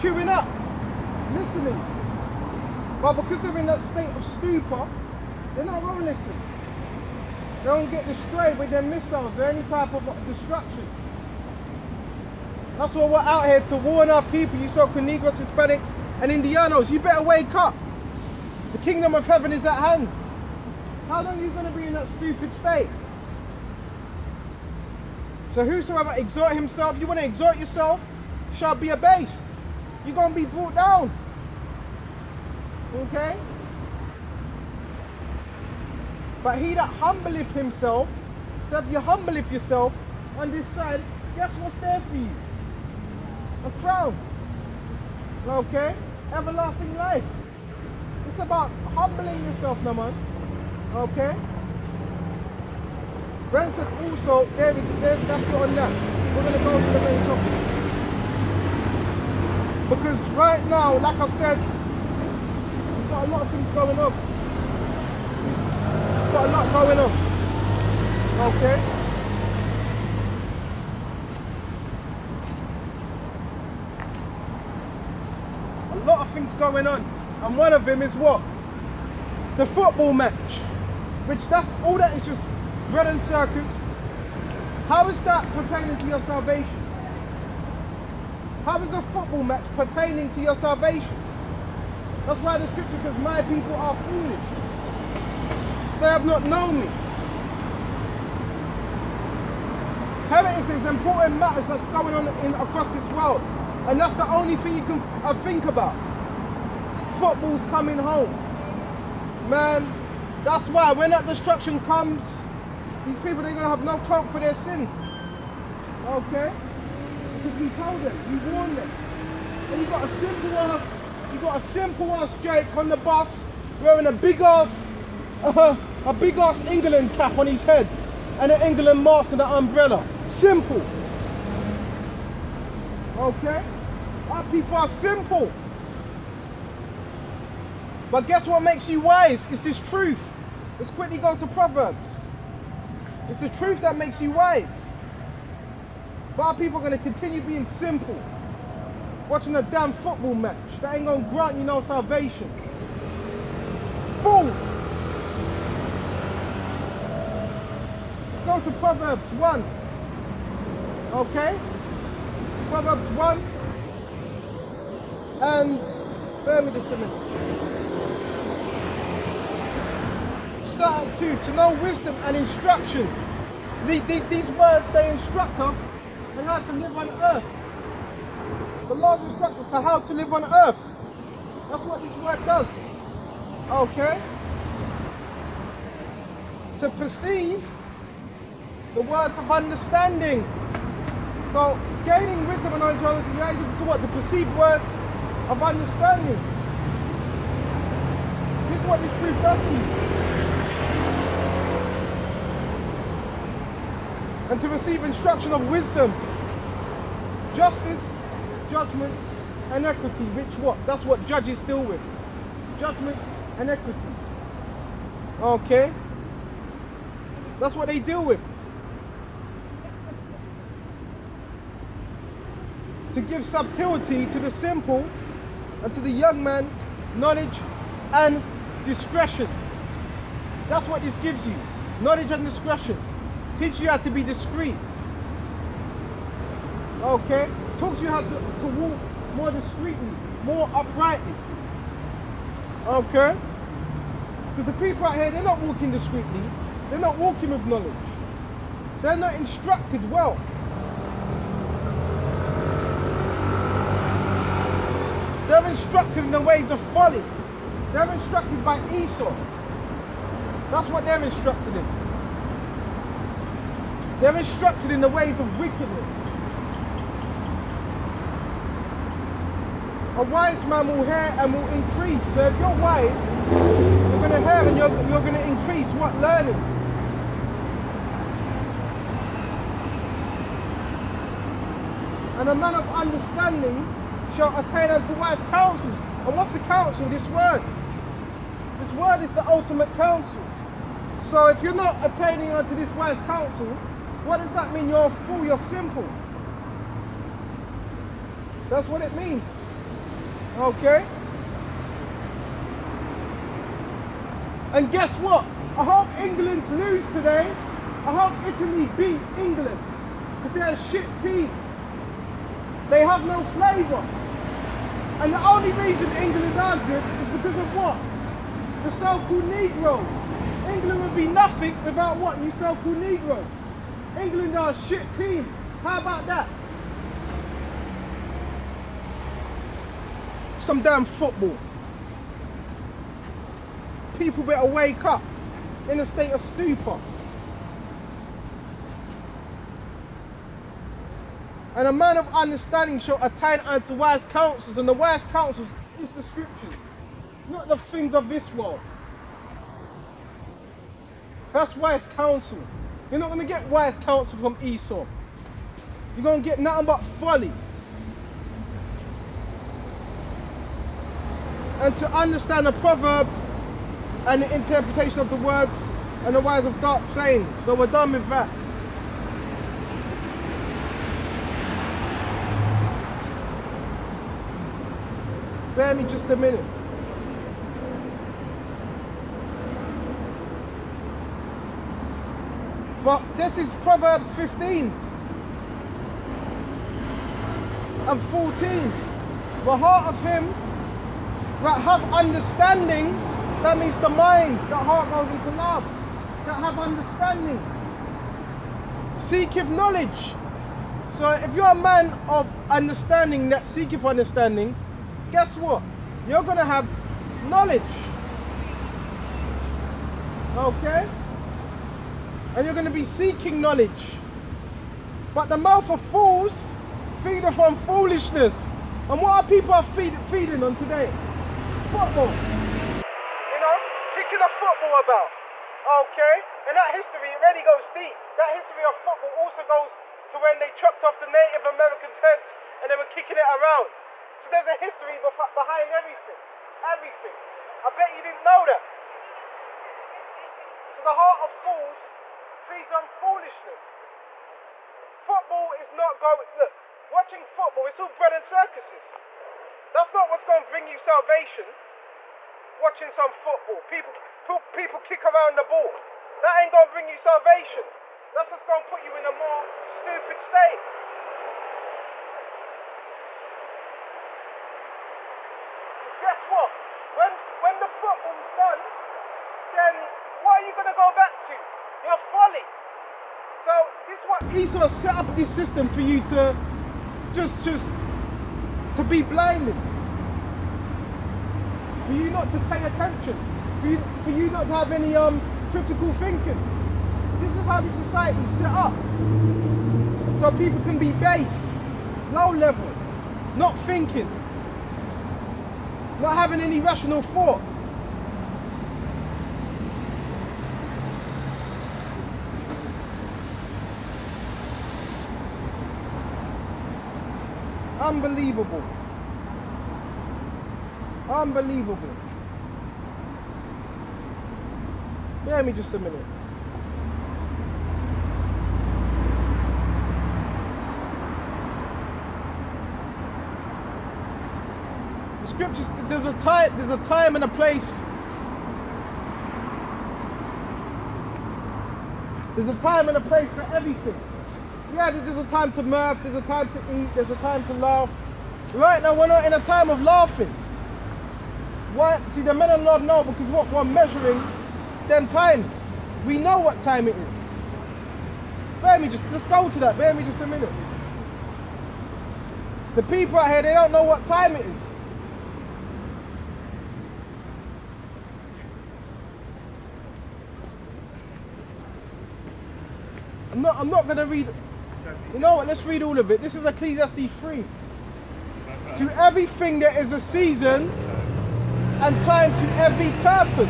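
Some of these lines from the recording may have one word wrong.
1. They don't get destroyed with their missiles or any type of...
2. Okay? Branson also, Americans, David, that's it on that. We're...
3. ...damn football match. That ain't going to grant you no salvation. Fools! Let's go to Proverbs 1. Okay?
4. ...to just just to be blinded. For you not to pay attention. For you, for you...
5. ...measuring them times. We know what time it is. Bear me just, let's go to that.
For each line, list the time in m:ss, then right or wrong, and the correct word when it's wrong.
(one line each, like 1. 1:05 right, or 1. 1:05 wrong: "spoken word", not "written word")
1. 0:07 right
2. 0:50 wrong: "David", not "Americans"
3. 2:29 right
4. 7:56 right
5. 9:03 right.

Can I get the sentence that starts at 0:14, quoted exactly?
You so Negros, Hispanics, and Indianos, you better wake up.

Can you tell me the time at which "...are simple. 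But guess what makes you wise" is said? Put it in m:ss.
2:14.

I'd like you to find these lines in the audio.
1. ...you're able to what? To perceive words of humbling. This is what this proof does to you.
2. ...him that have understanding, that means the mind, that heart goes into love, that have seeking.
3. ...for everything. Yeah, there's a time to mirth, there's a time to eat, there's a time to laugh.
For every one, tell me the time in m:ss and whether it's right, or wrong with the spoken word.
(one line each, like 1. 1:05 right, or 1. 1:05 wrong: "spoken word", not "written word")
1. 3:13 wrong: "understanding", not "humbling"
2. 6:30 wrong: "understanding", not "seeking"
3. 8:53 right.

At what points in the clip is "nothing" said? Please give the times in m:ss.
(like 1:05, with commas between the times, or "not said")
5:21, 5:56.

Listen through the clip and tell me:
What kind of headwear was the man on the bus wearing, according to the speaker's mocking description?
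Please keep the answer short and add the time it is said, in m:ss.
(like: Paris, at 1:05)
England cap, at 2:06.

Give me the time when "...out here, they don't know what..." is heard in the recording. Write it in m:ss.
9:13.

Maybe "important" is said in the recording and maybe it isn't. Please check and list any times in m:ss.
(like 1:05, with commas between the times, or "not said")
1:40.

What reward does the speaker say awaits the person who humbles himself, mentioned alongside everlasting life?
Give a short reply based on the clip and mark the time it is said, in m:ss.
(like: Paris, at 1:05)
A crown, at 0:43.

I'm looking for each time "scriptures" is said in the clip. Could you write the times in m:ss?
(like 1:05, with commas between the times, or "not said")
1:32, 5:46, 8:45.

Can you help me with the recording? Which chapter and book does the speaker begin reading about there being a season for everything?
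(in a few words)
Ecclesiastes 3.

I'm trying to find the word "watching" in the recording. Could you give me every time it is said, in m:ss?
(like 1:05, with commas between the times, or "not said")
2:29, 7:27, 7:32.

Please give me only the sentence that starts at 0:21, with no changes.
How long are you going to be in that stupid state?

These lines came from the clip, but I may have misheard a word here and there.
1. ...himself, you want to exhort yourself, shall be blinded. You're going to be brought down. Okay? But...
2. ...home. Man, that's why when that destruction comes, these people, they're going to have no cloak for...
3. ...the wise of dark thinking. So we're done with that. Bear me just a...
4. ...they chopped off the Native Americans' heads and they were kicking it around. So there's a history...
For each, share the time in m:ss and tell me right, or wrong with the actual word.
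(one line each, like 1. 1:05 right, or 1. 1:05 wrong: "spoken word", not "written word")
1. 0:26 wrong: "abased", not "blinded"
2. 1:47 right
3. 6:06 wrong: "saying", not "thinking"
4. 7:10 right.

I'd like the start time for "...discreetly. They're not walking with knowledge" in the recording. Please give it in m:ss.
4:05.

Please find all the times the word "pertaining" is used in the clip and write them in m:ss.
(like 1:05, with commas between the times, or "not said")
1:25, 1:29.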